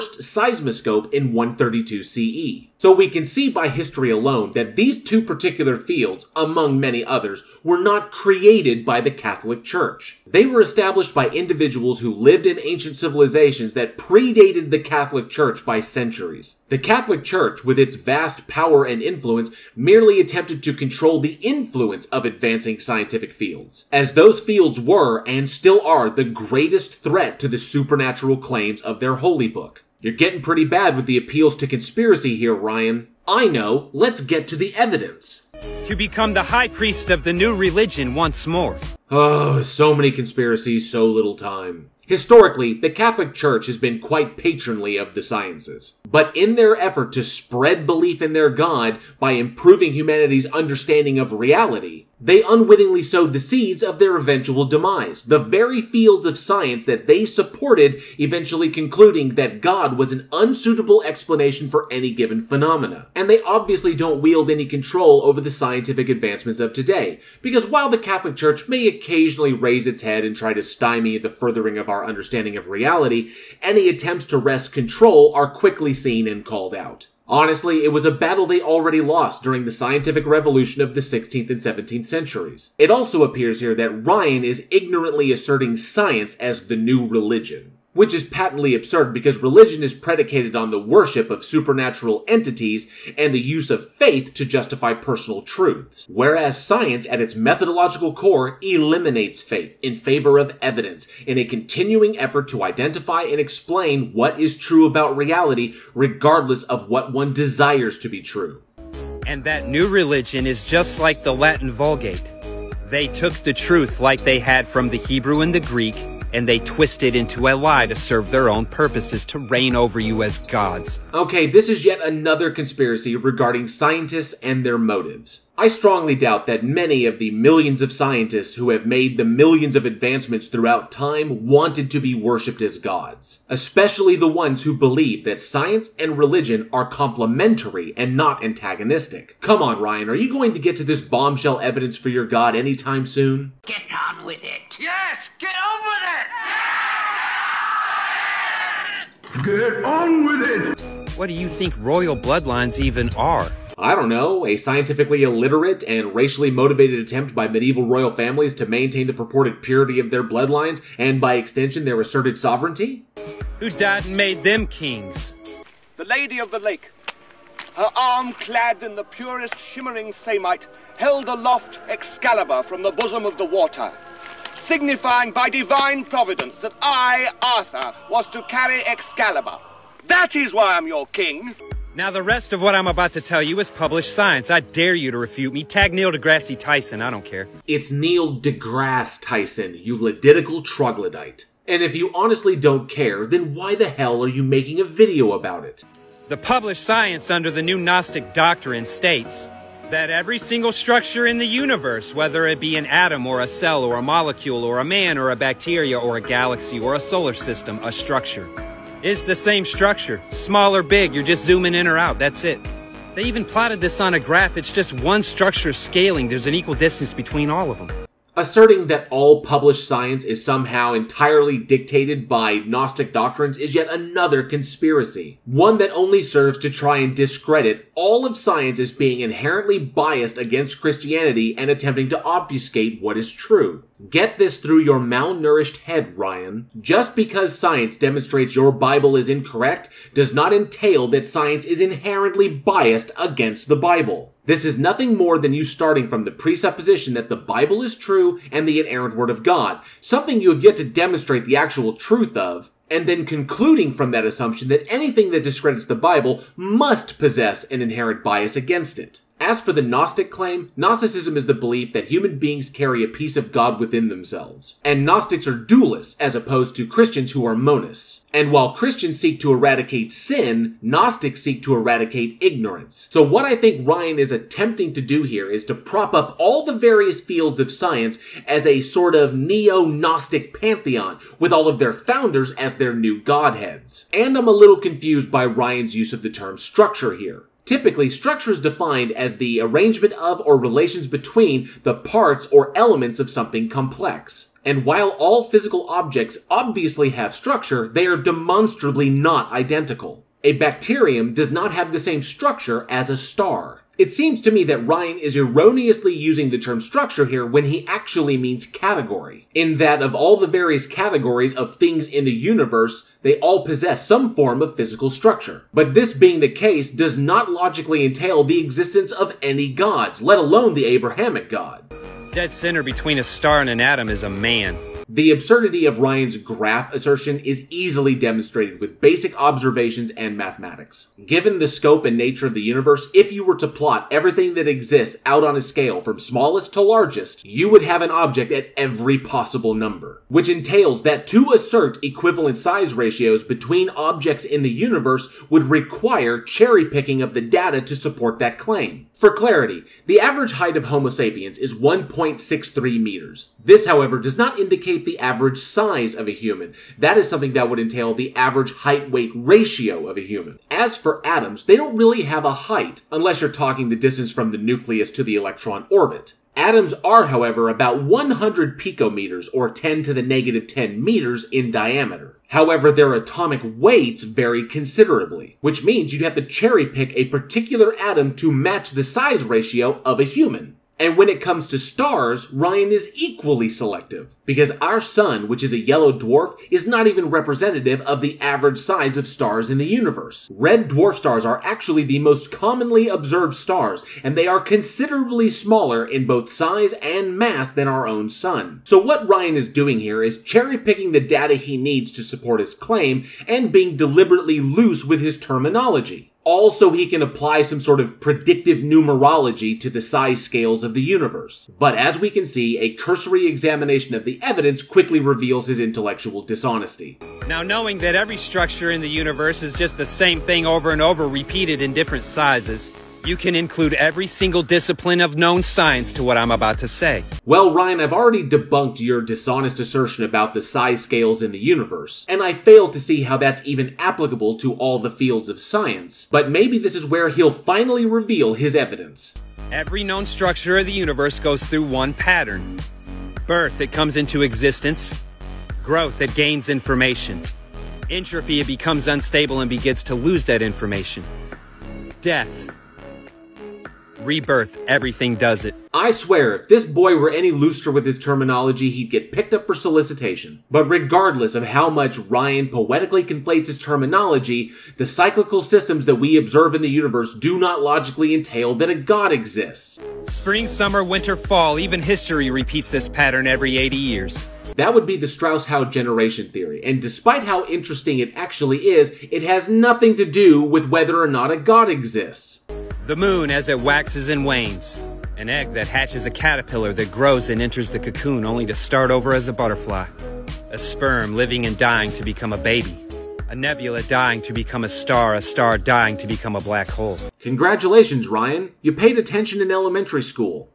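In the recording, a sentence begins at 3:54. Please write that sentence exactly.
Get this through your malnourished head, Ryan.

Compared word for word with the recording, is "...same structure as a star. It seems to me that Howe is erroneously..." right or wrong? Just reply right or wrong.
wrong.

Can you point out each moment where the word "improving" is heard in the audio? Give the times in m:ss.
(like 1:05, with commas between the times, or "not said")
0:49.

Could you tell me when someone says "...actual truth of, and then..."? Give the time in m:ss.
4:11.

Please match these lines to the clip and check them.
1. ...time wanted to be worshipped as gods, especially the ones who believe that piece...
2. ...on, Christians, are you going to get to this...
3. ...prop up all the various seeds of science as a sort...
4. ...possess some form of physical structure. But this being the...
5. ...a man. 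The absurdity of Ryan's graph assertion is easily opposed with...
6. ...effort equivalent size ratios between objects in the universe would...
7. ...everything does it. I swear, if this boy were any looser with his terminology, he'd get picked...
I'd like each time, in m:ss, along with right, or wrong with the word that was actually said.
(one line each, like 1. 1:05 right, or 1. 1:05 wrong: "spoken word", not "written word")
1. 2:10 wrong: "science", not "piece"
2. 2:19 wrong: "Ryan", not "Christians"
3. 4:35 wrong: "fields", not "seeds"
4. 5:13 right
5. 5:24 wrong: "demonstrated", not "opposed"
6. 5:41 wrong: "assert", not "effort"
7. 7:34 right.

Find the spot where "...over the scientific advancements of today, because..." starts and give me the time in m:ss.
1:05.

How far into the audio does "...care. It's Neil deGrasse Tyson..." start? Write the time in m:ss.
3:07.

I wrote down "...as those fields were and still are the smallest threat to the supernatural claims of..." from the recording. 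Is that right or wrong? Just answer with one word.
wrong.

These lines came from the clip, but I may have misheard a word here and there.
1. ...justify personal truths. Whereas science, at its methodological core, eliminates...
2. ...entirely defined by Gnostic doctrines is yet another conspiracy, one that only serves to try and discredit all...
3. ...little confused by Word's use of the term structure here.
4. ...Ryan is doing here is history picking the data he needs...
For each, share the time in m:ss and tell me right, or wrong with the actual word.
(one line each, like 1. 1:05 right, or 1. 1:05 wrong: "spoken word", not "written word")
1. 1:34 right
2. 3:40 wrong: "dictated", not "defined"
3. 4:44 wrong: "Ryan", not "Word"
4. 6:39 wrong: "cherry", not "history".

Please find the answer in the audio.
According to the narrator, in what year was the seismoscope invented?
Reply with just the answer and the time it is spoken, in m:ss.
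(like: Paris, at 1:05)
132 CE, at 0:01.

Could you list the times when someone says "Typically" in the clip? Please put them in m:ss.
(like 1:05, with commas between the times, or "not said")
4:47.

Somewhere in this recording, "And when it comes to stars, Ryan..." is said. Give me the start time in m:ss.
6:20.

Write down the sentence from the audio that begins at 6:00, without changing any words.
As for atoms, they don't really have a height, unless you're talking the distance from the nucleus to the electron orbit.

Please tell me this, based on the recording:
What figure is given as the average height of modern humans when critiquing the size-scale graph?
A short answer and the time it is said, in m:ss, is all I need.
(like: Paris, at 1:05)
1.63 meters, at 5:51.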